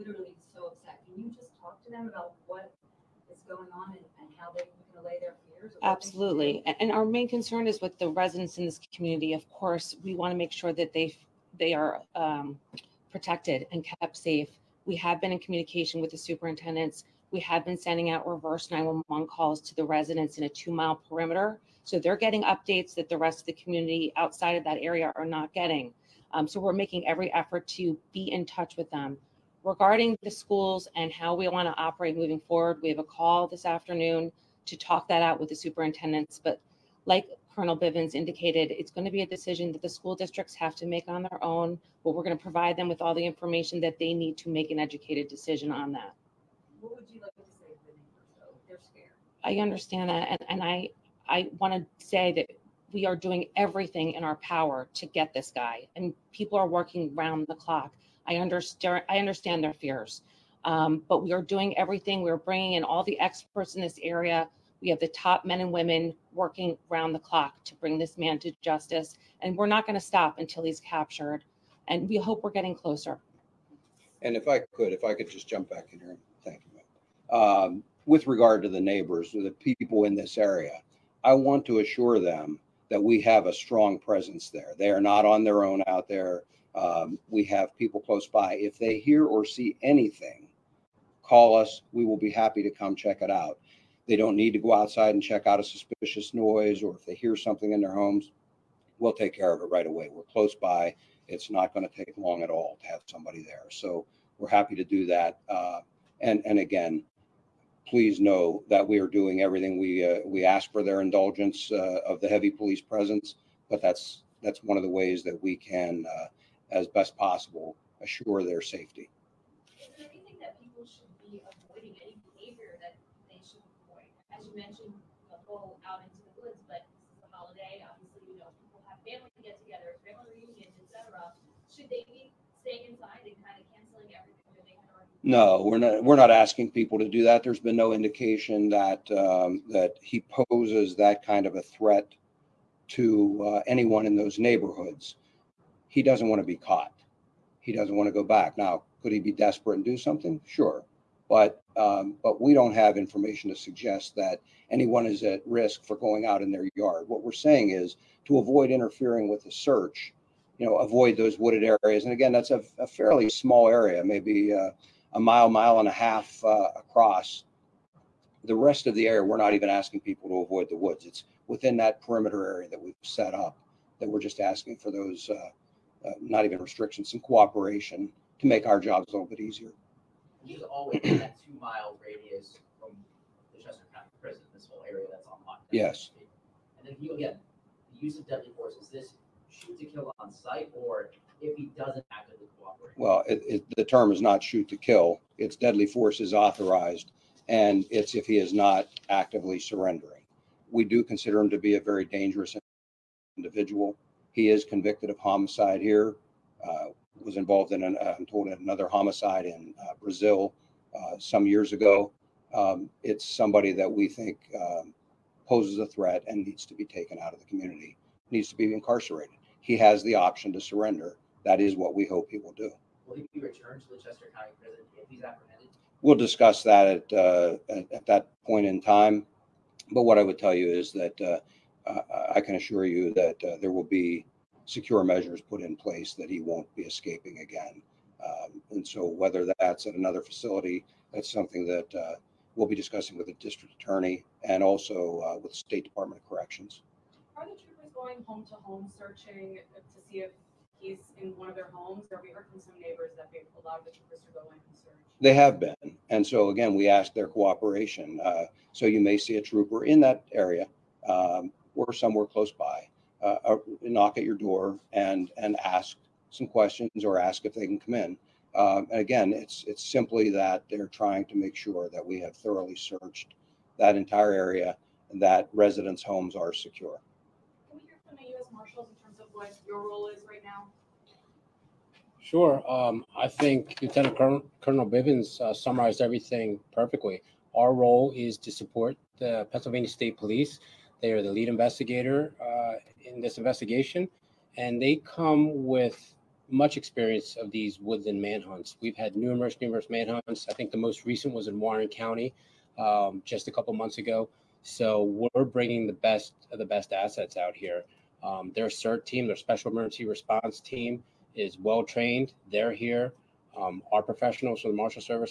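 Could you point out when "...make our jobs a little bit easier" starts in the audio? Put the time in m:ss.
2:58.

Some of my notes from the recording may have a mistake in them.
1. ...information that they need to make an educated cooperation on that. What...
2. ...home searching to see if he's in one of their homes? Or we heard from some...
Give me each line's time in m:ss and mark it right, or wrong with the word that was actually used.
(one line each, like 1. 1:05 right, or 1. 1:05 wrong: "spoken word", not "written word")
1. 0:43 wrong: "decision", not "cooperation"
2. 4:08 right.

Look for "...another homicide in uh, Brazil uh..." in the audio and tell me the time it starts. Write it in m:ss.
3:28.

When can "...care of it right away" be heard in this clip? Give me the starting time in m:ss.
1:39.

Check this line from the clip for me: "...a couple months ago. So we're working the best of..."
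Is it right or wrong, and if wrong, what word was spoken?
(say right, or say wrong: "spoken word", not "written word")
wrong: "bringing", not "working".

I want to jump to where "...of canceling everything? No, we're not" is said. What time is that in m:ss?
2:13.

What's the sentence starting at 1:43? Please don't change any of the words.
So we're happy to do that.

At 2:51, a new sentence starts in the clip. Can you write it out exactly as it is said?
It's within that perimeter area that we've set up that we're just asking for those.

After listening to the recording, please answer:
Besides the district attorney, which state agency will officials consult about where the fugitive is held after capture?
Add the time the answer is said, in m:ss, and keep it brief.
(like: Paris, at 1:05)
State Department of Corrections, at 4:05.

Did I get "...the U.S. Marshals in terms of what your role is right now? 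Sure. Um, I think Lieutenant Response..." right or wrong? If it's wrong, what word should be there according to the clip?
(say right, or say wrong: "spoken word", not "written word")
wrong: "Colonel", not "Response".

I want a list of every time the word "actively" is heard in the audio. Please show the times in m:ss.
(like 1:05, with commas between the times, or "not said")
3:12, 3:19.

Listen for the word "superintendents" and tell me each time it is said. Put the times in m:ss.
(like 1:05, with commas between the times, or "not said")
0:16, 0:35.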